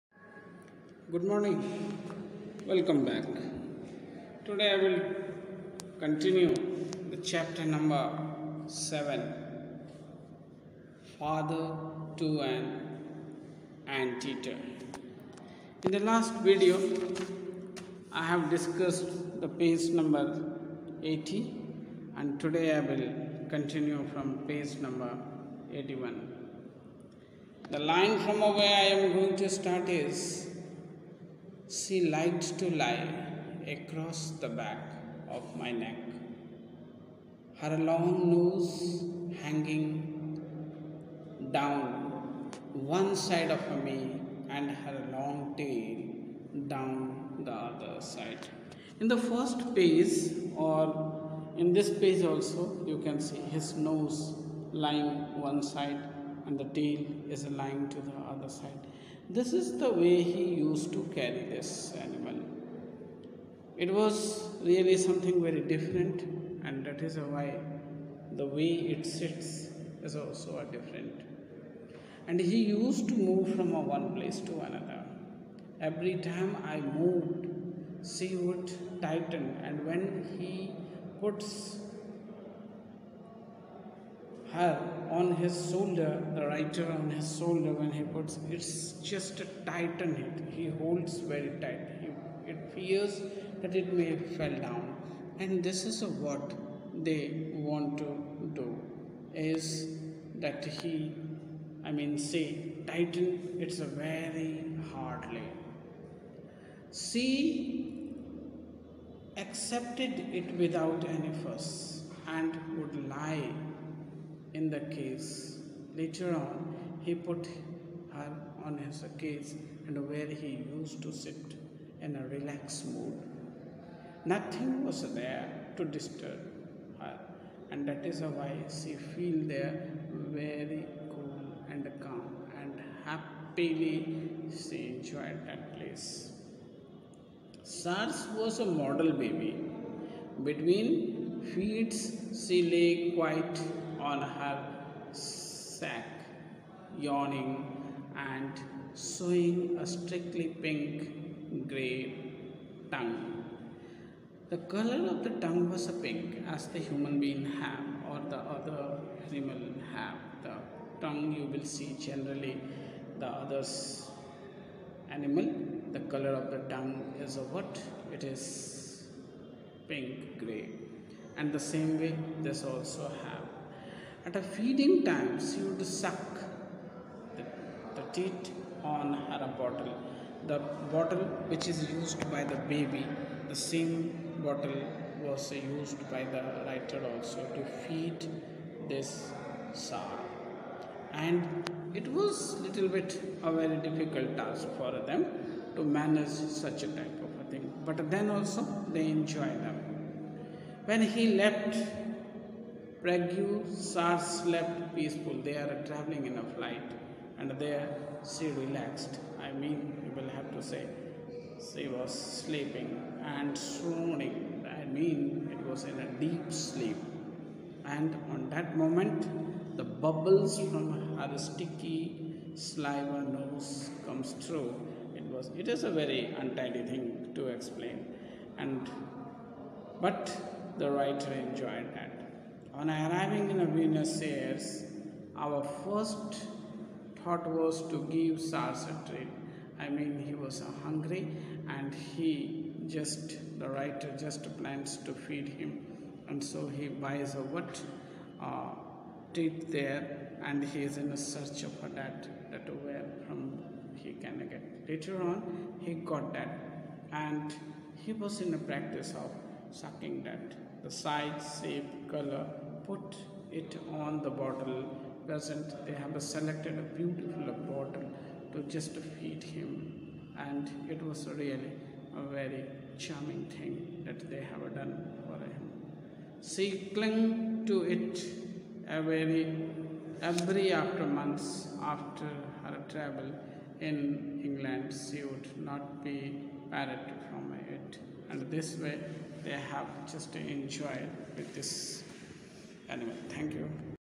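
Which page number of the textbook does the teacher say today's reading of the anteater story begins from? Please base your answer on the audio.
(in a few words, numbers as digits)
81.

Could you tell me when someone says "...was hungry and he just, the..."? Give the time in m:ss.
4:00.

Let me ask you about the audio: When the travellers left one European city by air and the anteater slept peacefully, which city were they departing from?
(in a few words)
Prague.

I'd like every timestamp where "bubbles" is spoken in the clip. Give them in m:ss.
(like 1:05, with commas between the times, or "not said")
3:39.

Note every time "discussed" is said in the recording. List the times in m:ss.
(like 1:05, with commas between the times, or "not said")
0:18.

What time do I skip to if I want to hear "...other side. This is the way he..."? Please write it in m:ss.
0:58.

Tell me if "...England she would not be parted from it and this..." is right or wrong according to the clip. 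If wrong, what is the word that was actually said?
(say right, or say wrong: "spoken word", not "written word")
right.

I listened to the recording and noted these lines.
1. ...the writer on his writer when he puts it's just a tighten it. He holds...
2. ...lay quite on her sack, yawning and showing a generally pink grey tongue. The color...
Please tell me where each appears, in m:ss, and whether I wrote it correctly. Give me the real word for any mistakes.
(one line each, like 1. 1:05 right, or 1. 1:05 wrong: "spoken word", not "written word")
1. 1:26 wrong: "shoulder", not "writer"
2. 2:22 wrong: "strictly", not "generally".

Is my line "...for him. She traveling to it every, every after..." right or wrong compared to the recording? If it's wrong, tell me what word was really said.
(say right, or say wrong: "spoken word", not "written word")
wrong: "clung", not "traveling".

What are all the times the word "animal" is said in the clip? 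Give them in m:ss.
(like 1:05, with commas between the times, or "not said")
1:02, 2:39, 2:45, 4:52.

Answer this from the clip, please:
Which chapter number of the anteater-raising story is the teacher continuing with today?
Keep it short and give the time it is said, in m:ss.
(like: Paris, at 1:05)
7, at 0:07.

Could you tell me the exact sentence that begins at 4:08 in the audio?
Uh, treat there and he is in a search of that, that where from he can get.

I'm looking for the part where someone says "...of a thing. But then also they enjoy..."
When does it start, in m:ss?
3:17.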